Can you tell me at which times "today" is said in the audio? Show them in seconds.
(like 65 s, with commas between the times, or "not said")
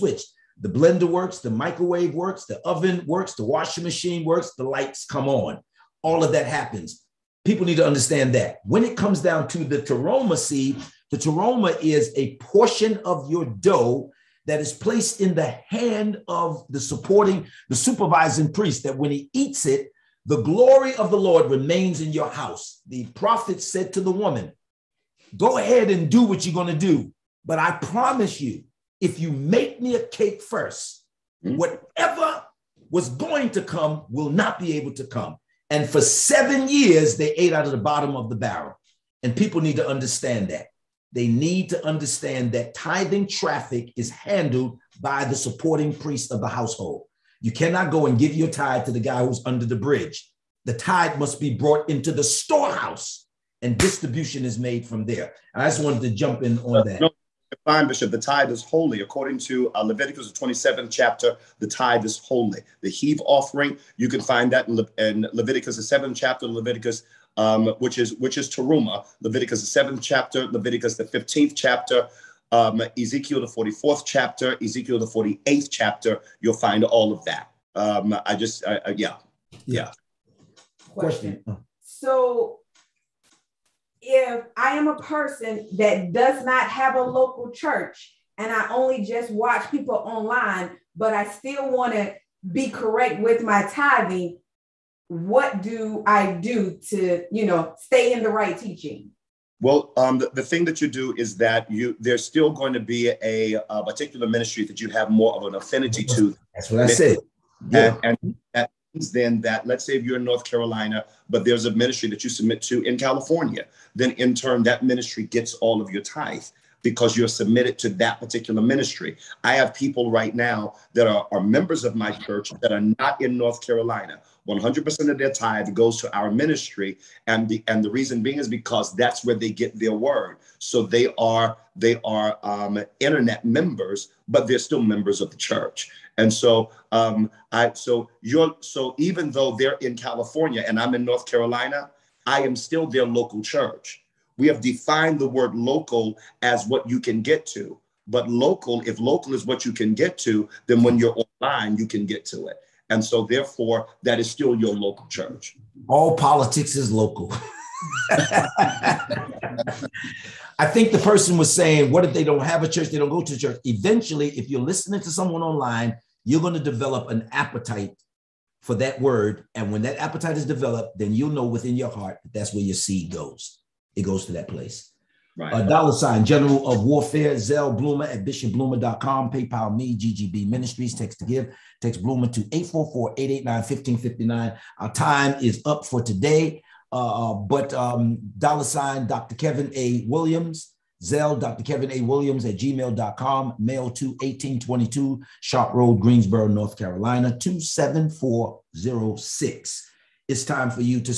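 186 s.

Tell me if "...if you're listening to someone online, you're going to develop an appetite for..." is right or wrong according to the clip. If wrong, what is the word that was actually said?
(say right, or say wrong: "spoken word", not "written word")
right.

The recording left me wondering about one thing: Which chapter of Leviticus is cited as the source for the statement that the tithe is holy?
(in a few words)
27th chapter.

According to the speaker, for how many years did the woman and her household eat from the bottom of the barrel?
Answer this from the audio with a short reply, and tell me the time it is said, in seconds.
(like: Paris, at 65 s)
7, at 35 s.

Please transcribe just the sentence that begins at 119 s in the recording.
I have people right now that are, are members of my church that are not in North Carolina.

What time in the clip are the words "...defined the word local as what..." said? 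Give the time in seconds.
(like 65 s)
144 s.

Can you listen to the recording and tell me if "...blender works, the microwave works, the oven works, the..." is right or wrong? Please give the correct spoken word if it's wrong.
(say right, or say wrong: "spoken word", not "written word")
right.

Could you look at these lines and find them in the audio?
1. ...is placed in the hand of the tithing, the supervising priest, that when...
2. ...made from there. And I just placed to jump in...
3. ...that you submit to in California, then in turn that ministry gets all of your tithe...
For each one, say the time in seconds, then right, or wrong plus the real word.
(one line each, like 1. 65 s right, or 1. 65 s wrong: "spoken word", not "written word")
1. 14 s wrong: "supporting", not "tithing"
2. 54 s wrong: "wanted", not "placed"
3. 112 s right.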